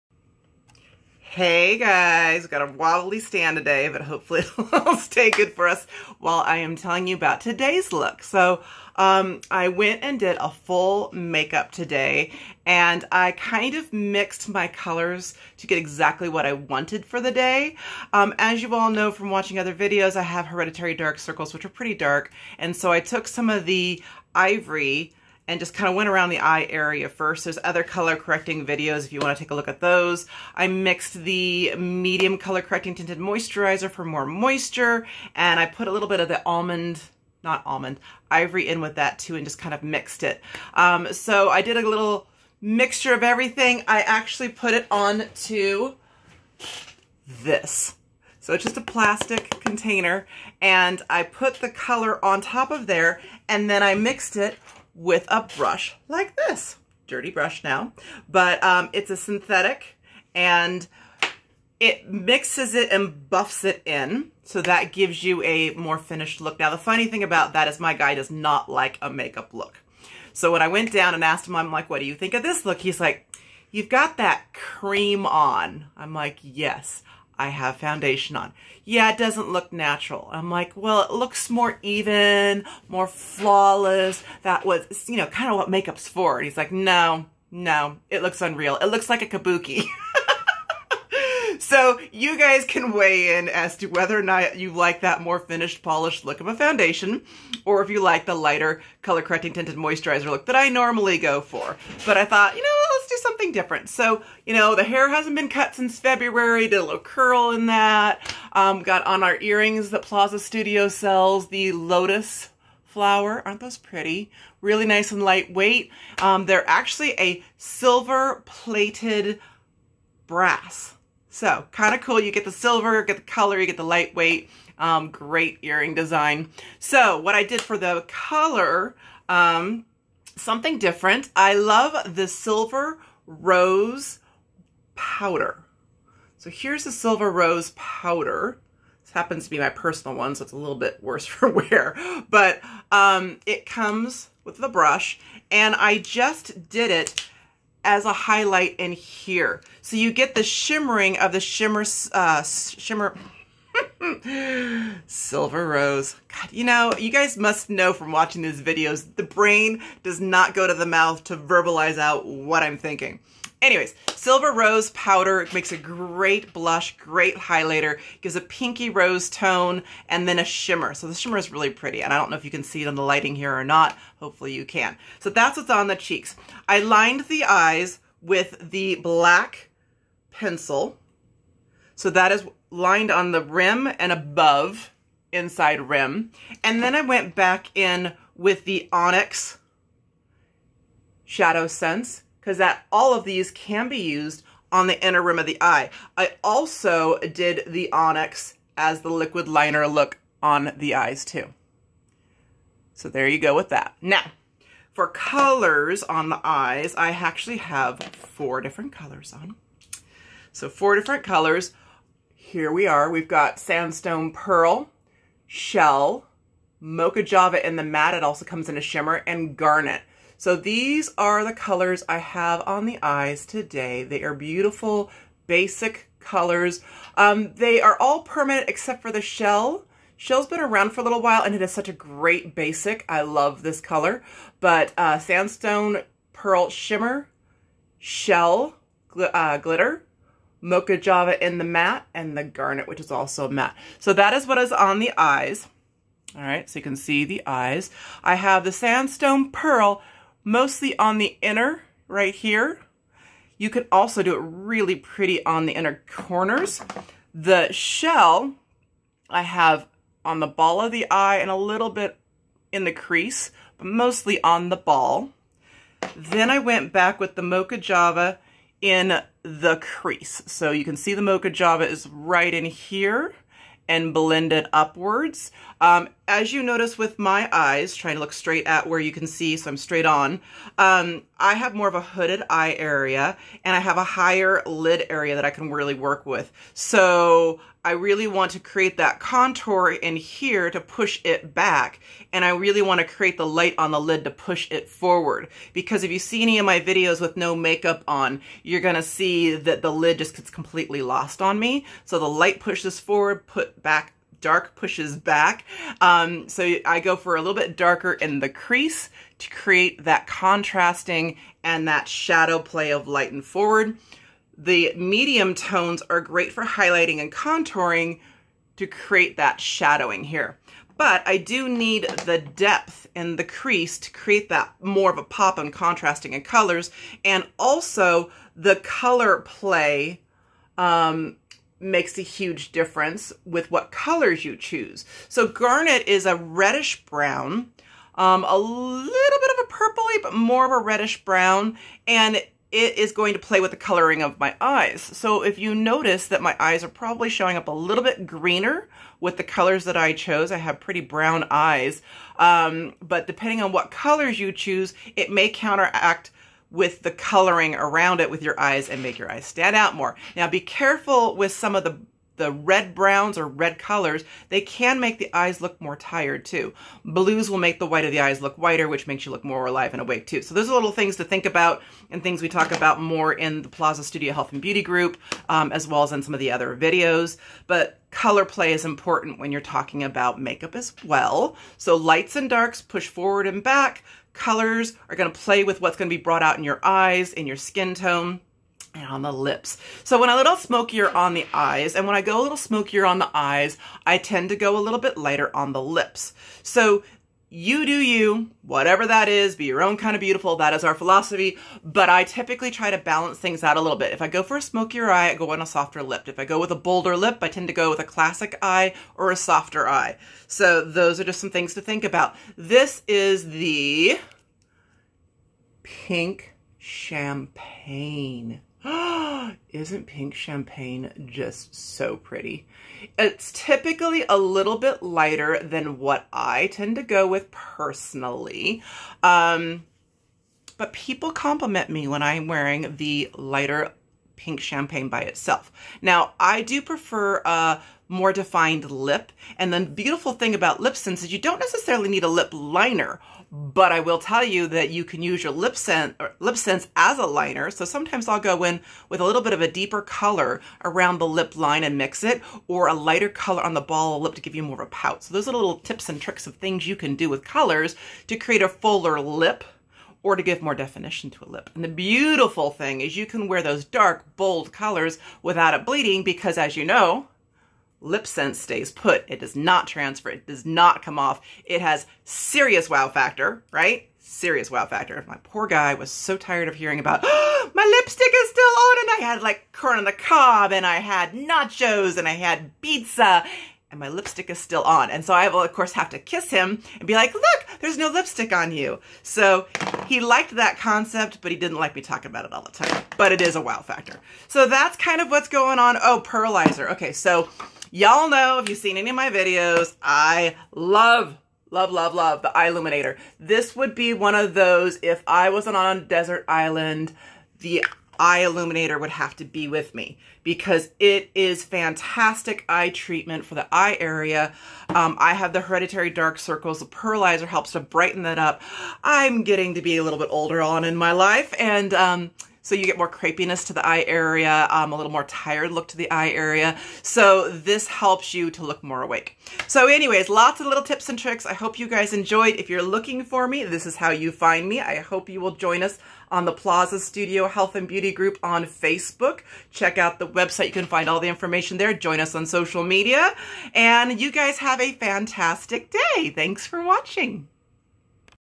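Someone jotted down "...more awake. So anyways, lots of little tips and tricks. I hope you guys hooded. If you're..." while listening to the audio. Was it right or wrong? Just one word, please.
wrong.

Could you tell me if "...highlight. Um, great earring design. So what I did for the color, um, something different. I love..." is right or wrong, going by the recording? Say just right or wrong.
wrong.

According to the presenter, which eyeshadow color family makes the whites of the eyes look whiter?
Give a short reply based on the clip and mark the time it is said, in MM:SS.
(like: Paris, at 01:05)
Blues, at 06:07.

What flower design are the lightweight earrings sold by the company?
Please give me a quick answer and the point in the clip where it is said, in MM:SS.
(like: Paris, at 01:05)
Lotus flower, at 01:51.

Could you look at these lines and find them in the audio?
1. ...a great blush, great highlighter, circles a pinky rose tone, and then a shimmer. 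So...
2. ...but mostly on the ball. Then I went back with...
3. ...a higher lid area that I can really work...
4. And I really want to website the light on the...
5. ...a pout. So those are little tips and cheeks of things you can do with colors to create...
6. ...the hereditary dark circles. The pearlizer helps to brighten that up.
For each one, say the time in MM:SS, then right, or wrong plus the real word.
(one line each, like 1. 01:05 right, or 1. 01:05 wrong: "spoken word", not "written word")
1. 02:45 wrong: "gives", not "circles"
2. 04:23 right
3. 04:43 right
4. 04:52 wrong: "create", not "website"
5. 07:34 wrong: "tricks", not "cheeks"
6. 08:35 right.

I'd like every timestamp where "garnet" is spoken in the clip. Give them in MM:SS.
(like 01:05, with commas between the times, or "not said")
03:39, 04:02, 05:35.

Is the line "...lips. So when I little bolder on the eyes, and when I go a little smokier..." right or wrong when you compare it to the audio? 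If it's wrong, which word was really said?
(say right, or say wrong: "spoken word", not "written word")
wrong: "smokier", not "bolder".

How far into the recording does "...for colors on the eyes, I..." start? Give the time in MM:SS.
03:24.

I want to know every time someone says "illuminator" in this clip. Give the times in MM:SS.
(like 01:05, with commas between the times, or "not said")
08:22, 08:28.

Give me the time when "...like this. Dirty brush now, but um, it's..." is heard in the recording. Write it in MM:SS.
00:56.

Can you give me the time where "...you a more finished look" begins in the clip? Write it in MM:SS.
01:05.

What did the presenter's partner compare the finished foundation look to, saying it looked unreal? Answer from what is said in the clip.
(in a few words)
a kabuki.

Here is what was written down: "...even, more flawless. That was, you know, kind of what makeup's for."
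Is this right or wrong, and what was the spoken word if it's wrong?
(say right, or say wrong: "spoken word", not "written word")
right.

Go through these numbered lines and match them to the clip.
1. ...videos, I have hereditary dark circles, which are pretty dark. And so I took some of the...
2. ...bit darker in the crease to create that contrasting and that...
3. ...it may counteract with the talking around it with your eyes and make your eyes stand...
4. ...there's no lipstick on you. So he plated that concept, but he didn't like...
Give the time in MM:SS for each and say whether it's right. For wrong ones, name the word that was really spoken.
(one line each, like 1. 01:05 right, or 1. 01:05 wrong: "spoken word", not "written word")
1. 00:19 right
2. 05:07 right
3. 05:55 wrong: "coloring", not "talking"
4. 08:07 wrong: "liked", not "plated".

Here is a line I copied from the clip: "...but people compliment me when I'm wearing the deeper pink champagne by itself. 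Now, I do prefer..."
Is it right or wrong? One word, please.
wrong.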